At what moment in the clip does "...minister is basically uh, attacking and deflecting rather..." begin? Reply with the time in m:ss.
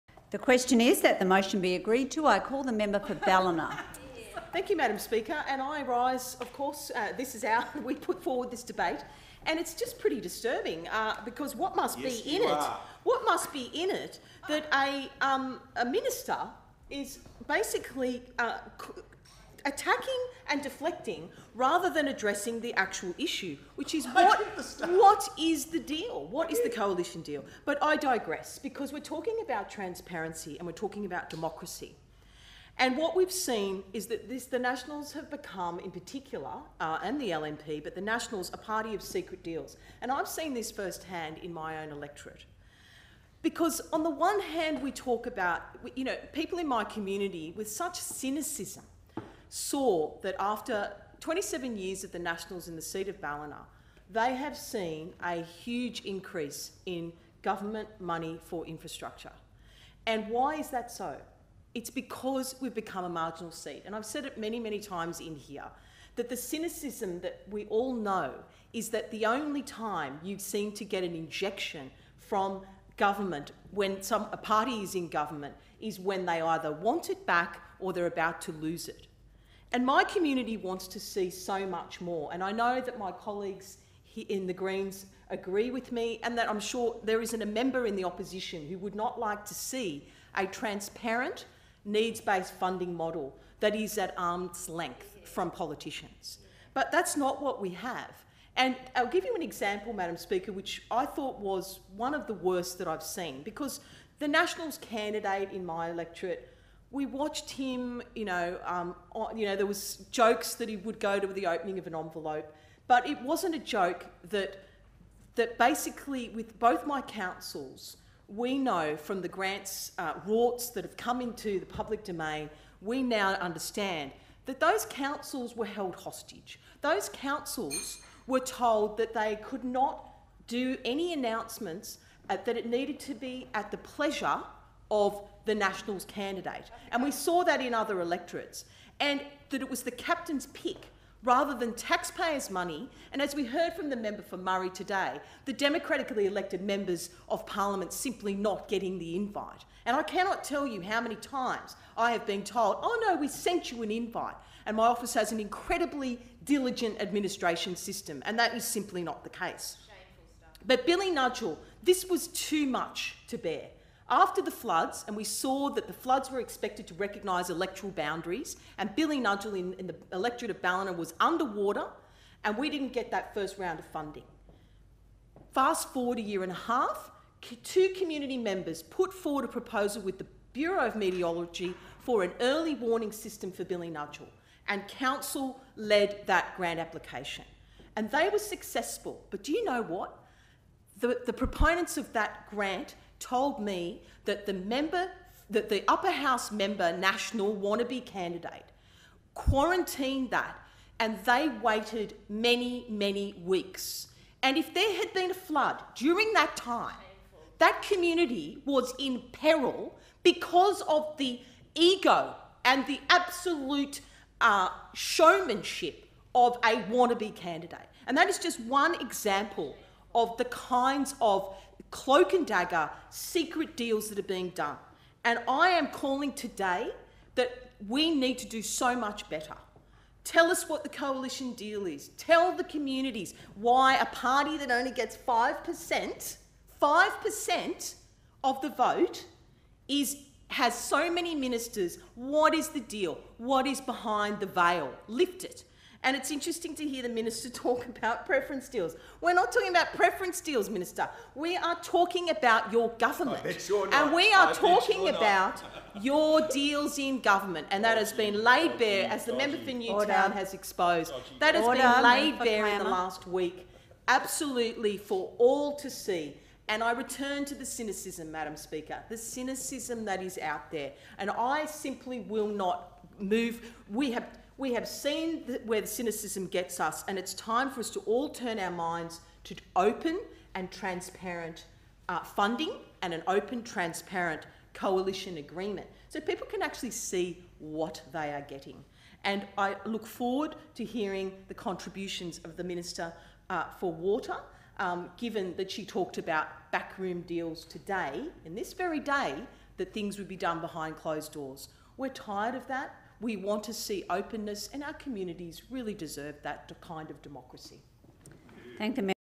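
0:15.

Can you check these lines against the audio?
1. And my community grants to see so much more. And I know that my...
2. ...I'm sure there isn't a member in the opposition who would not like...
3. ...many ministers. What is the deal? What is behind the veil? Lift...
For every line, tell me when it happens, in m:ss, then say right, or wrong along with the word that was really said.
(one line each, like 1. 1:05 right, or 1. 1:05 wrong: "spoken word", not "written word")
1. 1:19 wrong: "wants", not "grants"
2. 1:26 right
3. 4:01 right.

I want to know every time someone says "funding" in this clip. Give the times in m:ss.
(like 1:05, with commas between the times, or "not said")
1:32, 2:53, 4:42.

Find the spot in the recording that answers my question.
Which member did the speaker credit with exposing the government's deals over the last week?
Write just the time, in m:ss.
4:19.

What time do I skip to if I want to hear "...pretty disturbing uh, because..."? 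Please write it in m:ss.
0:09.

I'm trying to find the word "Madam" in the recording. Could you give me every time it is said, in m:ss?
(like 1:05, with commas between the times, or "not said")
0:04, 1:39, 4:28.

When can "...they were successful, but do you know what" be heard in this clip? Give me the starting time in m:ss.
3:08.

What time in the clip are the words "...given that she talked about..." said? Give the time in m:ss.
4:55.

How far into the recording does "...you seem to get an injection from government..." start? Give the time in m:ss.
1:10.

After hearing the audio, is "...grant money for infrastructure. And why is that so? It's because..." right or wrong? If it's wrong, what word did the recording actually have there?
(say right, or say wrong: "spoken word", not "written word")
wrong: "government", not "grant".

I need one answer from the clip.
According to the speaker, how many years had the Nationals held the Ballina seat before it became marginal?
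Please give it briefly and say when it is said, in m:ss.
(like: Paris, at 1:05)
27, at 0:51.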